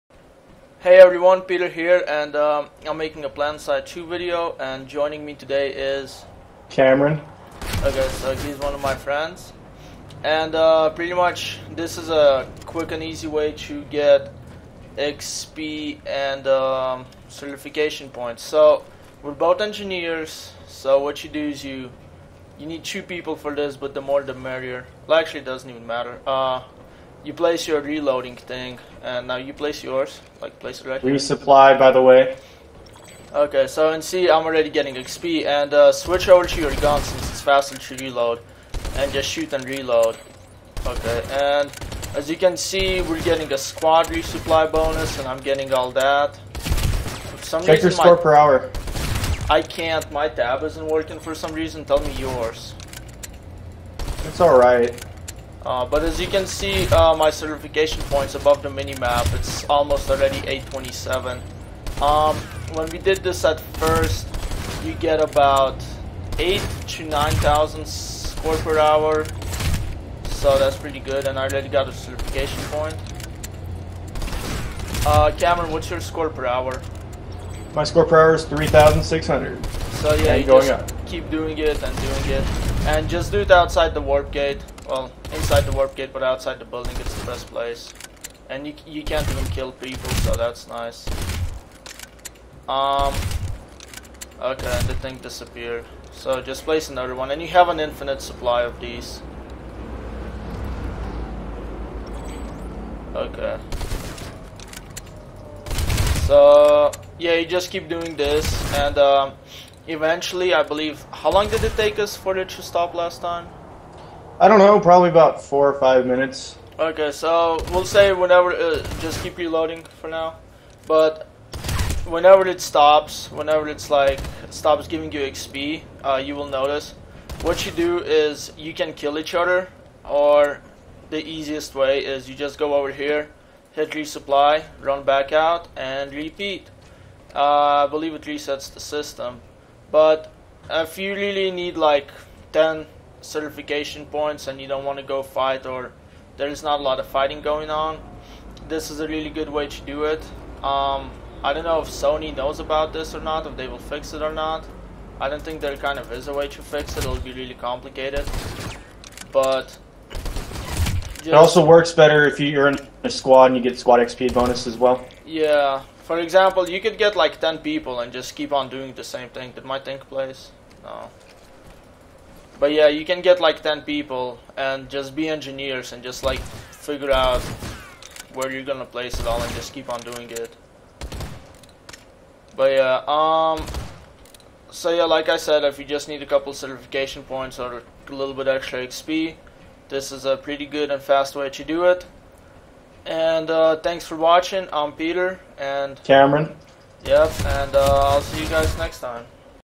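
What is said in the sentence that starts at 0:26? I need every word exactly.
Uh, you place your reloading thing, and now you place yours.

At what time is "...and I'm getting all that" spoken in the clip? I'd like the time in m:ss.
0:45.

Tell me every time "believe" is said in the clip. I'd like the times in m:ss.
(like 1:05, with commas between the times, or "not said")
1:50, 2:17.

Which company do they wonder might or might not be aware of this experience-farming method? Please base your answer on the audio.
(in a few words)
Sony.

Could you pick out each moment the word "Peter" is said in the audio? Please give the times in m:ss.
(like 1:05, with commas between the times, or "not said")
0:01, 3:14.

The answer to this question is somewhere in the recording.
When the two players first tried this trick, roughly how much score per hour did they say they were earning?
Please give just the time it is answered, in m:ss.
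1:06.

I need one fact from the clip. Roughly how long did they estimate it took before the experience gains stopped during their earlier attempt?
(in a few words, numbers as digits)
4 or 5 minutes.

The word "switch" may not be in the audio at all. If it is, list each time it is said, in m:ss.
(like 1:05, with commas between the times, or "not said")
0:35.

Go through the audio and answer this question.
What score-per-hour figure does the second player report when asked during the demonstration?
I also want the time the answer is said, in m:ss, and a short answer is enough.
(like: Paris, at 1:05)
3,600, at 1:18.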